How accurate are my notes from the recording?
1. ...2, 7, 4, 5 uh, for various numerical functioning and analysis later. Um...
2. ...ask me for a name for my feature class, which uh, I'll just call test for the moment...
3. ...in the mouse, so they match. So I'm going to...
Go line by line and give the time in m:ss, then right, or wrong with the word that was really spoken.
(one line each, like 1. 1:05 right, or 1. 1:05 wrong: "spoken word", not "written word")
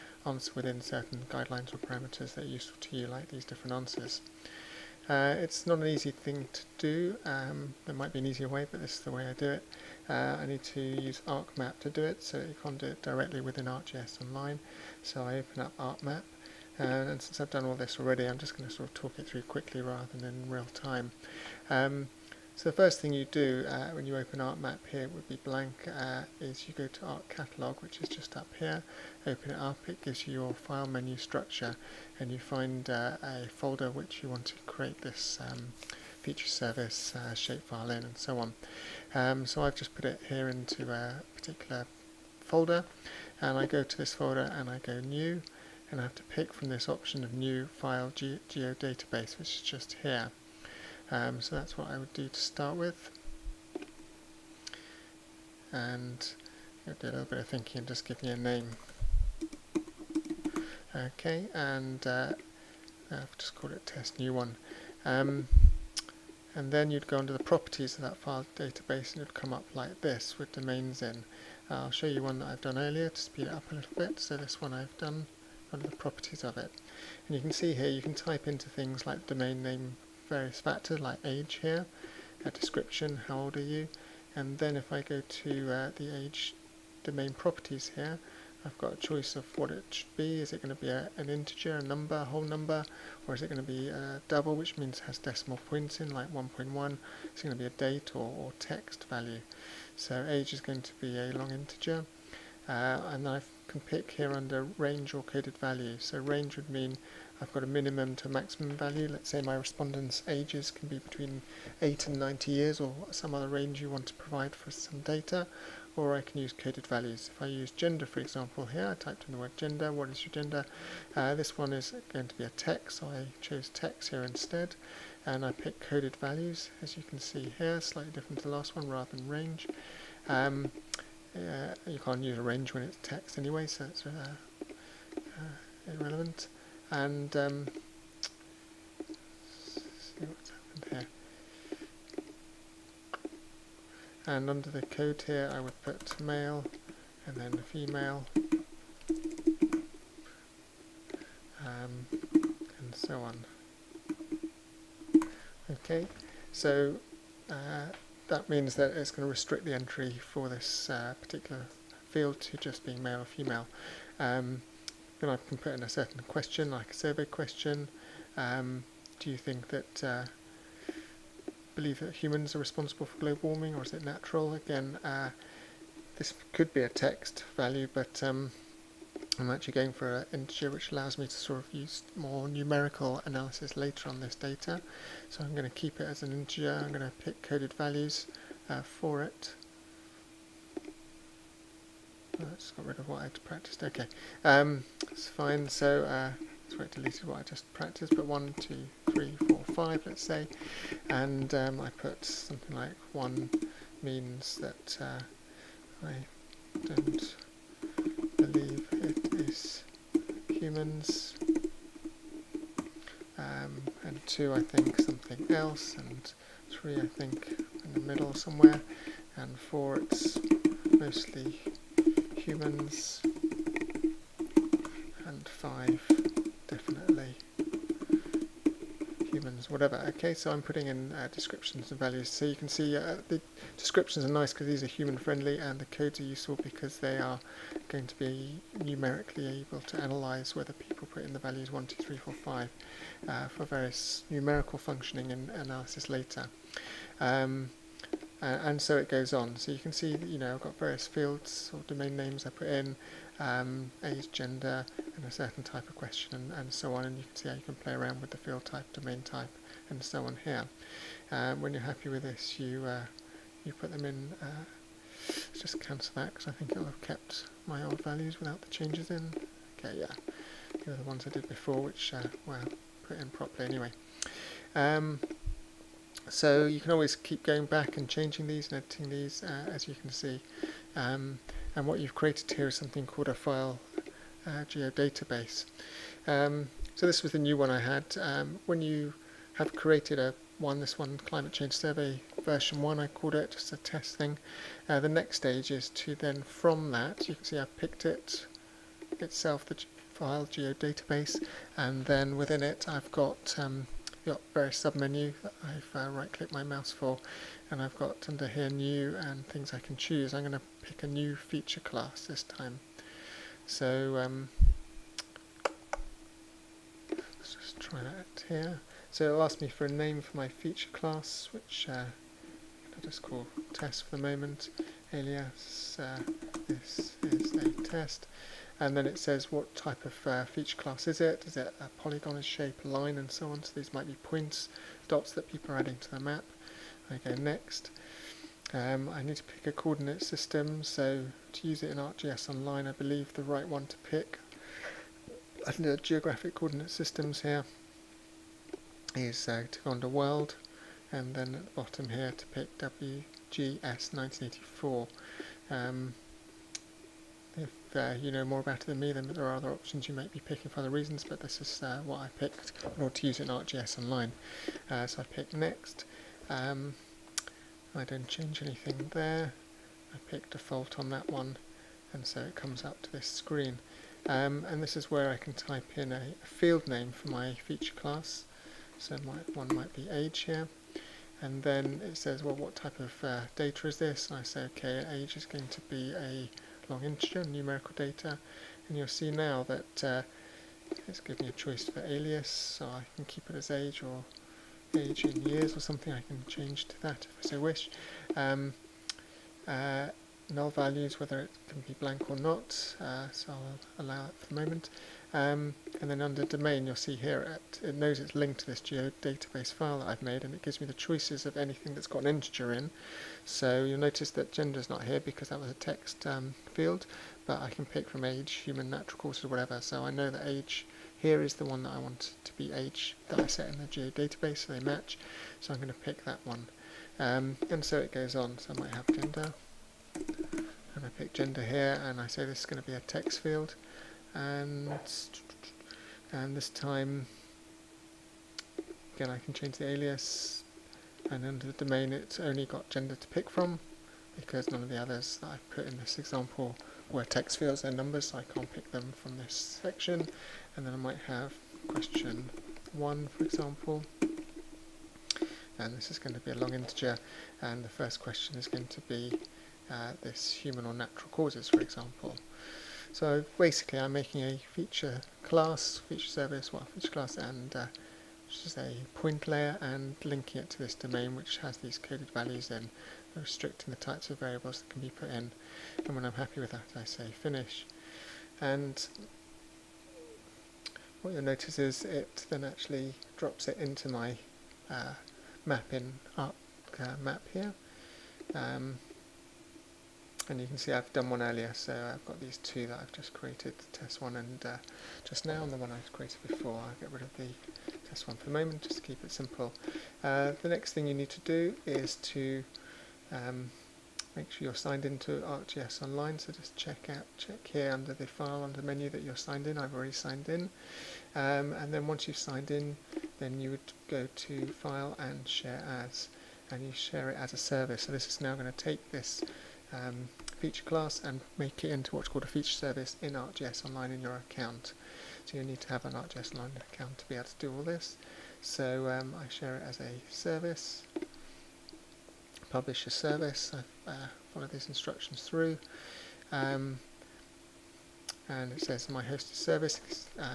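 1. 4:01 wrong: "3", not "7"
2. 5:19 right
3. 7:03 wrong: "geodatabase", not "mouse".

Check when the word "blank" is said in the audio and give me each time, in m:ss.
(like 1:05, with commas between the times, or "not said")
0:25, 6:42.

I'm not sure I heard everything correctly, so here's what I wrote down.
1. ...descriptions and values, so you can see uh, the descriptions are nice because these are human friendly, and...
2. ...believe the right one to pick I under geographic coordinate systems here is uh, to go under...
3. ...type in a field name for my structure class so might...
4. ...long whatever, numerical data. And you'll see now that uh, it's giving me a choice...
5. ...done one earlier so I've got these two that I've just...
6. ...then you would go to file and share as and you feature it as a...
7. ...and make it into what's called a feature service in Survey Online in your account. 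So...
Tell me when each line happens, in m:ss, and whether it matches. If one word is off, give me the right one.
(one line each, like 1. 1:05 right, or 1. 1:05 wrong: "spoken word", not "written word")
1. 3:51 right
2. 5:42 right
3. 6:15 wrong: "feature", not "structure"
4. 6:26 wrong: "integer", not "whatever"
5. 8:11 right
6. 8:33 wrong: "share", not "feature"
7. 8:41 wrong: "ArcGIS", not "Survey".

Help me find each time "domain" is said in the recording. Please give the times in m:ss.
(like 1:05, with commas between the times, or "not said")
1:10, 1:19, 1:27, 4:11, 4:18, 6:46, 7:21, 7:50.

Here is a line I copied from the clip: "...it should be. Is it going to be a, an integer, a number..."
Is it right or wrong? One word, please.
right.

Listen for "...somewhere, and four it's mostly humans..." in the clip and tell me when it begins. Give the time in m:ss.
3:38.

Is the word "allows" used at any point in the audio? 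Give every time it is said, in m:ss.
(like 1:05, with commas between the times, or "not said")
3:00, 6:44.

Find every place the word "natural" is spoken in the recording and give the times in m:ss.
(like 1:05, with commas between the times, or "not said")
2:54, 6:58, 7:40.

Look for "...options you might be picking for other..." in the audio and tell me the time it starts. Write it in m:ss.
5:59.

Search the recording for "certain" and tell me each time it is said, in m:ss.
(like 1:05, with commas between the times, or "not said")
0:00, 2:45, 4:15.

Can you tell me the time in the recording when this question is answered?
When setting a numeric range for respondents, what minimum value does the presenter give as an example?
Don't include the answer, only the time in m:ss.
1:51.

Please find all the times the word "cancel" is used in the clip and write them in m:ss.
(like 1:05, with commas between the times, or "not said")
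4:25.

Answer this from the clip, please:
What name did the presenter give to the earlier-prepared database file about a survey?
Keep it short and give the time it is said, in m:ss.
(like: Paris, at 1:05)
Climate Change Survey version 1, at 4:51.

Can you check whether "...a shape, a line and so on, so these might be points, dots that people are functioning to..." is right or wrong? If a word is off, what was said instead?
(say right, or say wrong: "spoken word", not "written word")
wrong: "adding", not "functioning".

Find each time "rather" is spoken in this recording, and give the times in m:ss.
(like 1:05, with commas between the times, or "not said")
0:19, 2:08.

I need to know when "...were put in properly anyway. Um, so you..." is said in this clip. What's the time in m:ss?
4:32.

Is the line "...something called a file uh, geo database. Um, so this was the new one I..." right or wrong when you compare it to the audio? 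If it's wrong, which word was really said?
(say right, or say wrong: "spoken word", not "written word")
right.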